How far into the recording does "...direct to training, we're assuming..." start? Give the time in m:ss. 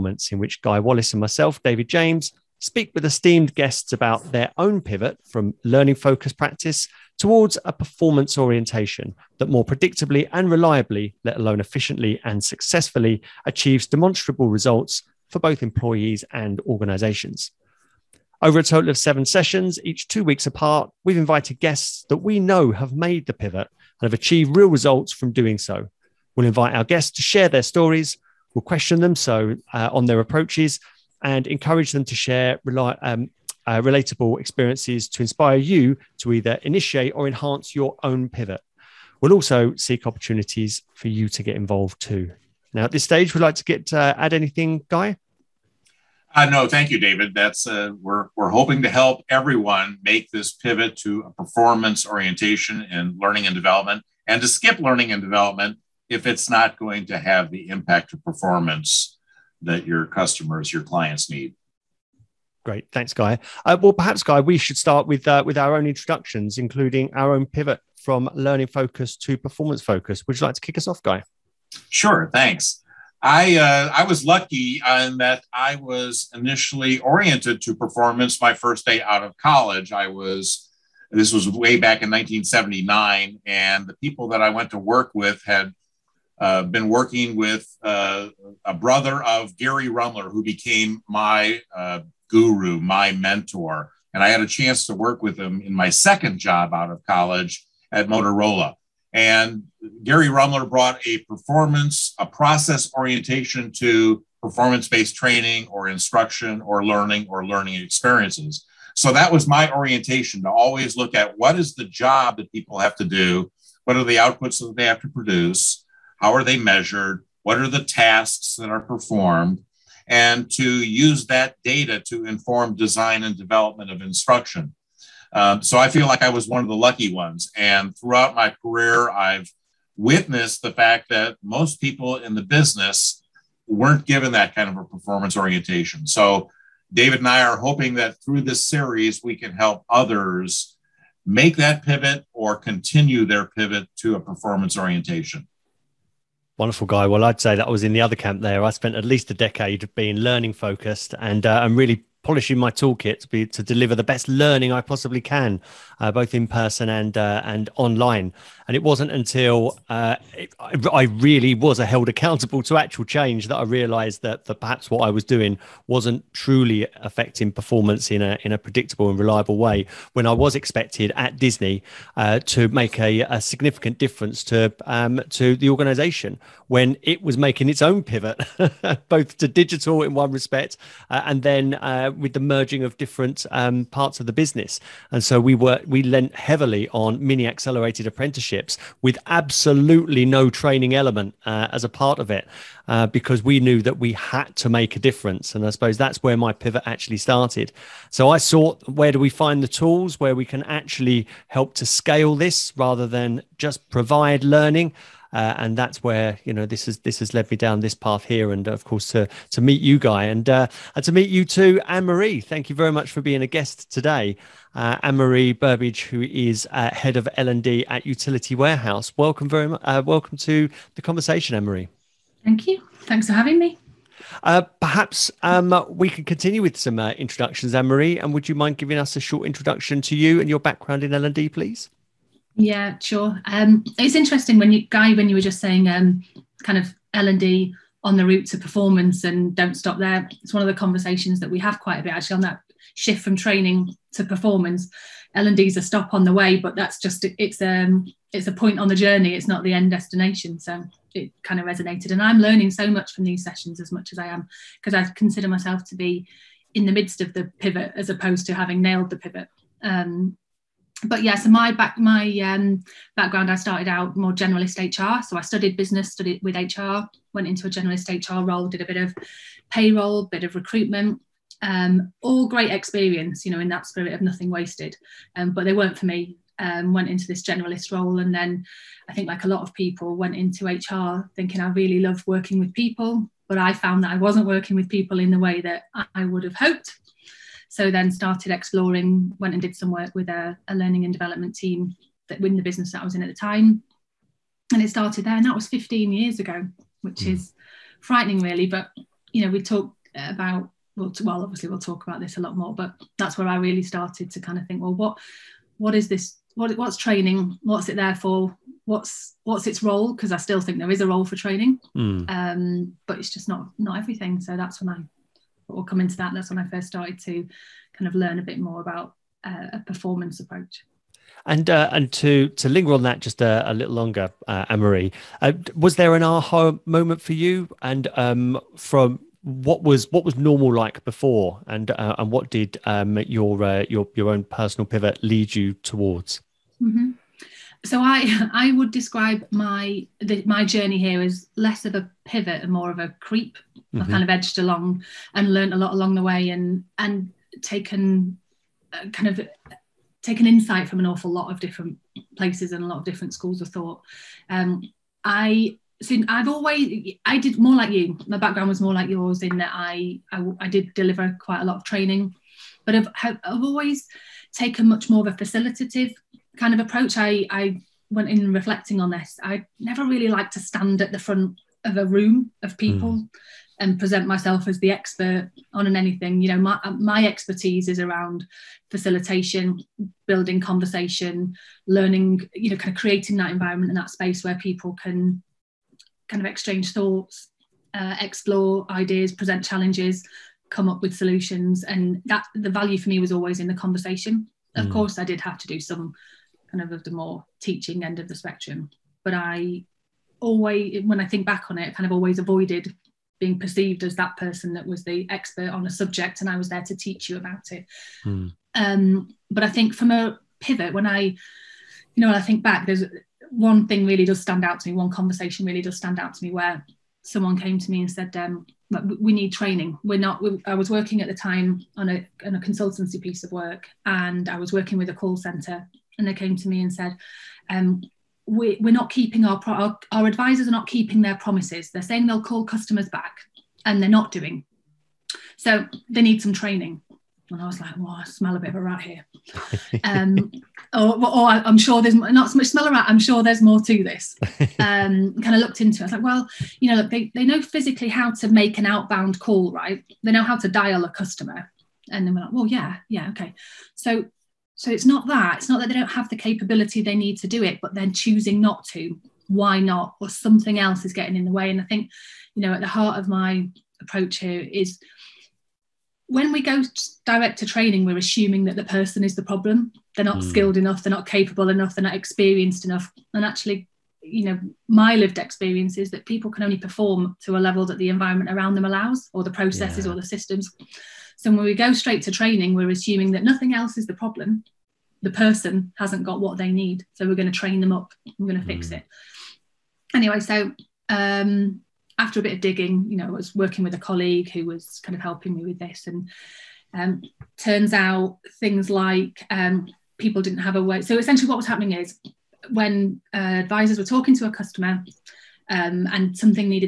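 7:47.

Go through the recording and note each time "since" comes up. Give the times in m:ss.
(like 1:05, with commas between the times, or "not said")
5:56.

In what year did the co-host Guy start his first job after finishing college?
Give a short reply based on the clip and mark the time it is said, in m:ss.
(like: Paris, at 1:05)
1979, at 1:22.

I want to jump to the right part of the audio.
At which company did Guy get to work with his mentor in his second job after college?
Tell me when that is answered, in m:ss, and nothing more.
1:38.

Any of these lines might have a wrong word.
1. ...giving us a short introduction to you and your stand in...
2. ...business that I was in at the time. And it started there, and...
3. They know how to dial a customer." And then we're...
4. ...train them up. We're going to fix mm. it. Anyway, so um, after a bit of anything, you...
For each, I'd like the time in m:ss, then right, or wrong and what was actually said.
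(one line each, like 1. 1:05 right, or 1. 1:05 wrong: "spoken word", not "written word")
1. 3:48 wrong: "background", not "stand"
2. 4:52 right
3. 7:30 right
4. 8:07 wrong: "digging", not "anything".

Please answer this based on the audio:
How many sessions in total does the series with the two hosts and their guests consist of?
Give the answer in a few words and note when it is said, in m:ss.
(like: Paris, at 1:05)
7, at 0:18.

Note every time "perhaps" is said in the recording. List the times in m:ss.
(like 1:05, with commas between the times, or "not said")
1:03, 2:44, 3:44.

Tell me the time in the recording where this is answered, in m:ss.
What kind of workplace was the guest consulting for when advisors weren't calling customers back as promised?
7:05.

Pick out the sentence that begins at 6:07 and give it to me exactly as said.
I I went in reflecting on this.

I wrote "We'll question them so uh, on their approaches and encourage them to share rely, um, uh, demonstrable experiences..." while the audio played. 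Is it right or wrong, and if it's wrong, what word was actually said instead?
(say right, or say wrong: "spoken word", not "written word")
wrong: "relatable", not "demonstrable".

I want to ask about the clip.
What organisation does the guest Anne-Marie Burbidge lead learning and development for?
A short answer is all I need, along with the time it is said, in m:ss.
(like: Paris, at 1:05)
Utility Warehouse, at 3:38.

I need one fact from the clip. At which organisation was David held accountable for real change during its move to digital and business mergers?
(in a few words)
Disney.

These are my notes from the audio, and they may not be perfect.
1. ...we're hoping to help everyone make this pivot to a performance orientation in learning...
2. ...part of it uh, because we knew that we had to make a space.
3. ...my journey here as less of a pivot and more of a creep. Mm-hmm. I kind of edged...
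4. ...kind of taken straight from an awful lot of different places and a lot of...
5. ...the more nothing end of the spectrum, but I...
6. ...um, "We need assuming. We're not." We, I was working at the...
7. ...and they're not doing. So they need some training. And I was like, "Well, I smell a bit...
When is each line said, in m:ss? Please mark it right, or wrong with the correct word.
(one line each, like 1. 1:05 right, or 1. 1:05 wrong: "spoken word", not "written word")
1. 0:48 right
2. 3:11 wrong: "difference", not "space"
3. 5:40 right
4. 5:49 wrong: "insight", not "straight"
5. 6:37 wrong: "teaching", not "nothing"
6. 6:58 wrong: "training", not "assuming"
7. 7:13 right.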